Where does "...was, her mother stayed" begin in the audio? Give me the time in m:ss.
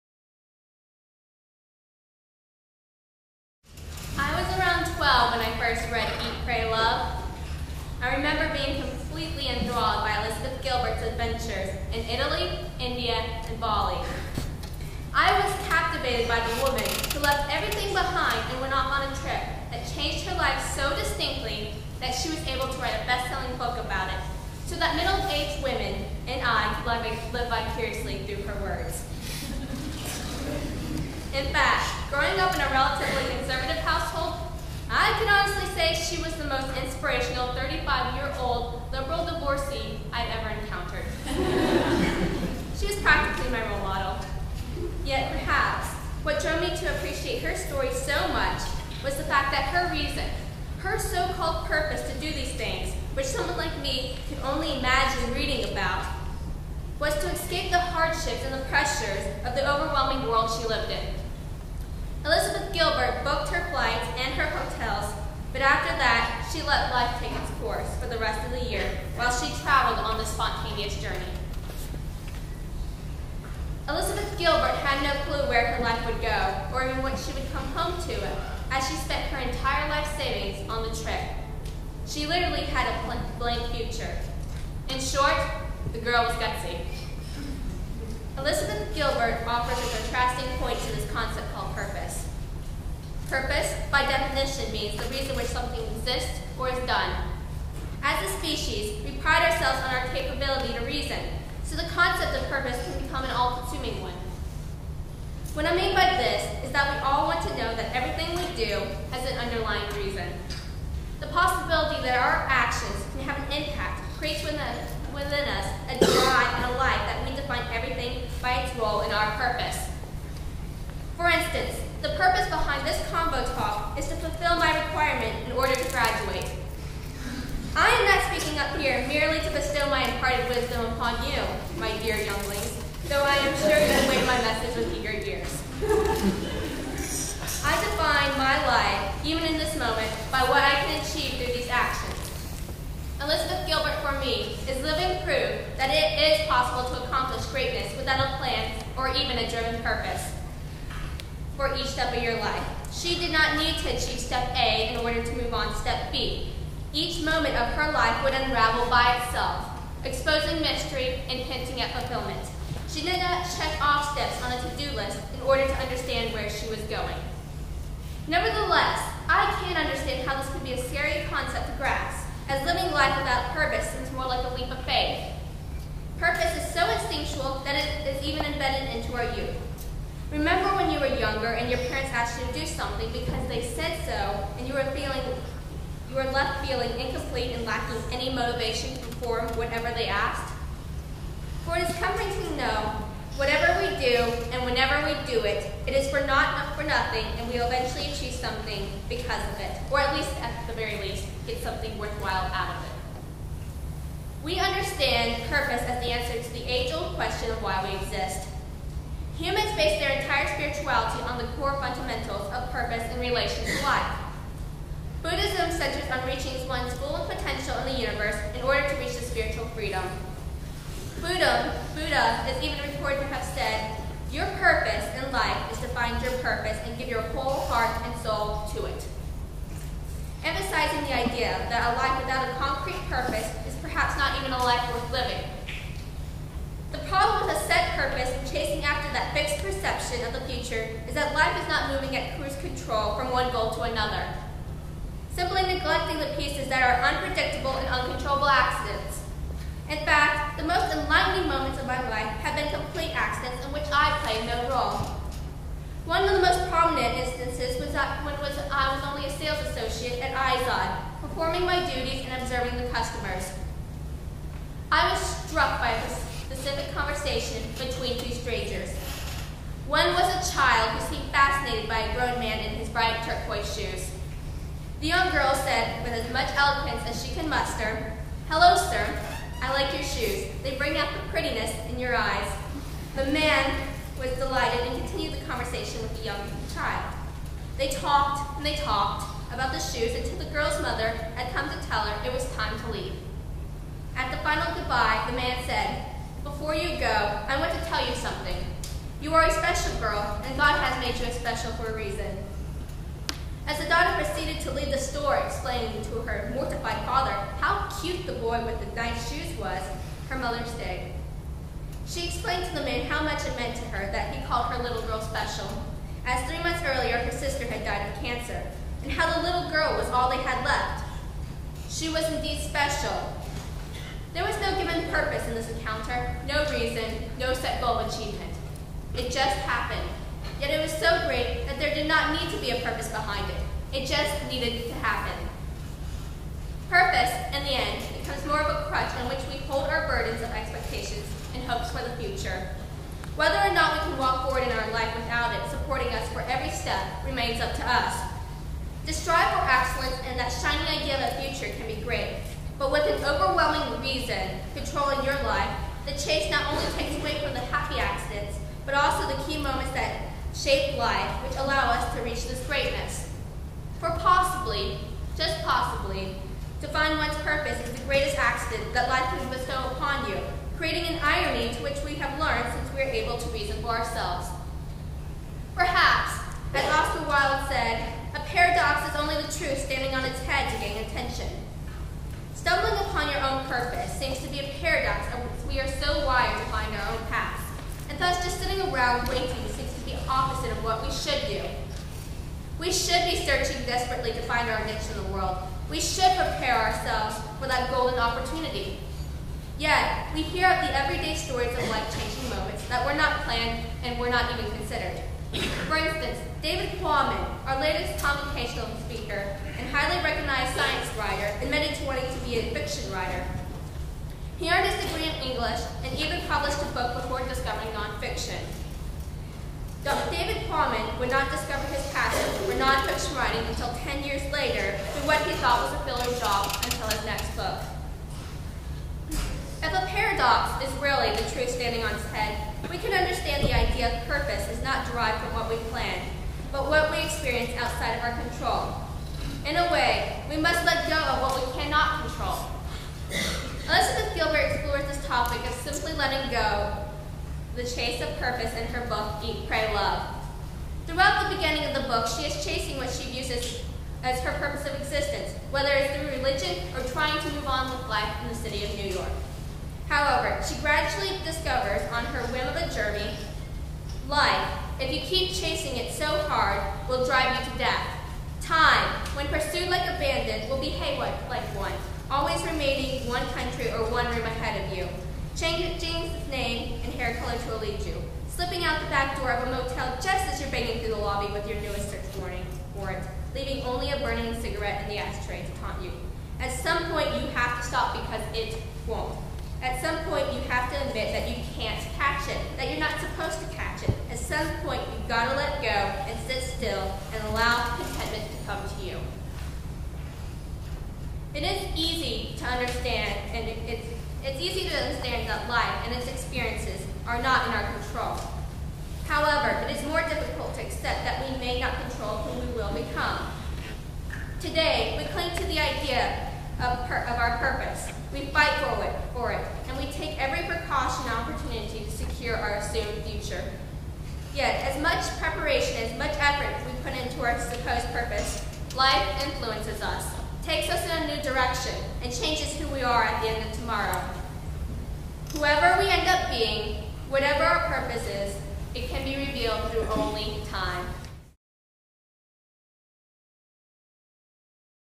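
5:09.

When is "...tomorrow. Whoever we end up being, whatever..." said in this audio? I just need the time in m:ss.
8:53.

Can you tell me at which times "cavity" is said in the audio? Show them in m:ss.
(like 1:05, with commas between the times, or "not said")
not said.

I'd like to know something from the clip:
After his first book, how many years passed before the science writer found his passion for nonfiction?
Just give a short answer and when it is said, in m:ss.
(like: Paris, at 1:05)
10, at 7:04.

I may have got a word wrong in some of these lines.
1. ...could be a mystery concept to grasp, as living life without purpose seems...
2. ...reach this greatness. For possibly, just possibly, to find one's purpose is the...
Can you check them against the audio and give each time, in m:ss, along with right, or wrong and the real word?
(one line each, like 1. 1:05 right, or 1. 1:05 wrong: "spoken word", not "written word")
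1. 2:50 wrong: "scary", not "mystery"
2. 6:02 right.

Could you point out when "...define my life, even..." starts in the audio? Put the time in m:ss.
2:17.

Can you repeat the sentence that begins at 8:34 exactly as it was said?
Today, we cling to the idea of, per, of our purpose.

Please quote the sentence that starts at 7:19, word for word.
In a way, we must let go of what we cannot control.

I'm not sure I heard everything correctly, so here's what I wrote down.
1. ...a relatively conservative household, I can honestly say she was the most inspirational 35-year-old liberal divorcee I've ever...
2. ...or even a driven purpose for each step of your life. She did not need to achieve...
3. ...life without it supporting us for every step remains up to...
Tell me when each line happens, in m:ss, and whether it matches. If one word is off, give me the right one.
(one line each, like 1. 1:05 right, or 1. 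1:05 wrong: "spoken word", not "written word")
1. 0:32 right
2. 2:28 right
3. 5:44 right.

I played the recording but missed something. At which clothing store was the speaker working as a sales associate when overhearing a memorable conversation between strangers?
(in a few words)
IZOD.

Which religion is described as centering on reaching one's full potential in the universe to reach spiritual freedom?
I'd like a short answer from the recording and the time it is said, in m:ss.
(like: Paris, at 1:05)
Buddhism, at 3:35.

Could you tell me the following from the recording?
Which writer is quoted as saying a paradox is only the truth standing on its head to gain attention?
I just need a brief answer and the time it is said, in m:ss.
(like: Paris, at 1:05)
Oscar Wilde, at 6:16.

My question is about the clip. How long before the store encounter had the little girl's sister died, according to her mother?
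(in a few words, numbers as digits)
3 months.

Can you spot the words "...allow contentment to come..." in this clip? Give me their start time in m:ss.
8:17.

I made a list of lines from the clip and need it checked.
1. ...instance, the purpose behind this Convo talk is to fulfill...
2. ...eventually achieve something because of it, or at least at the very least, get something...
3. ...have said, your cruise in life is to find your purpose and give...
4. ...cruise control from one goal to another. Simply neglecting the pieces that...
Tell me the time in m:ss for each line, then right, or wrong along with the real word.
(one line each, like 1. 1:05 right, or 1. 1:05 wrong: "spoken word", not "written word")
1. 2:01 right
2. 3:17 right
3. 3:43 wrong: "purpose", not "cruise"
4. 4:02 right.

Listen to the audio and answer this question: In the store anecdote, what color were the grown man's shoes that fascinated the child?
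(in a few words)
Turquoise.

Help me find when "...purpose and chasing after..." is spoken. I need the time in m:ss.
3:57.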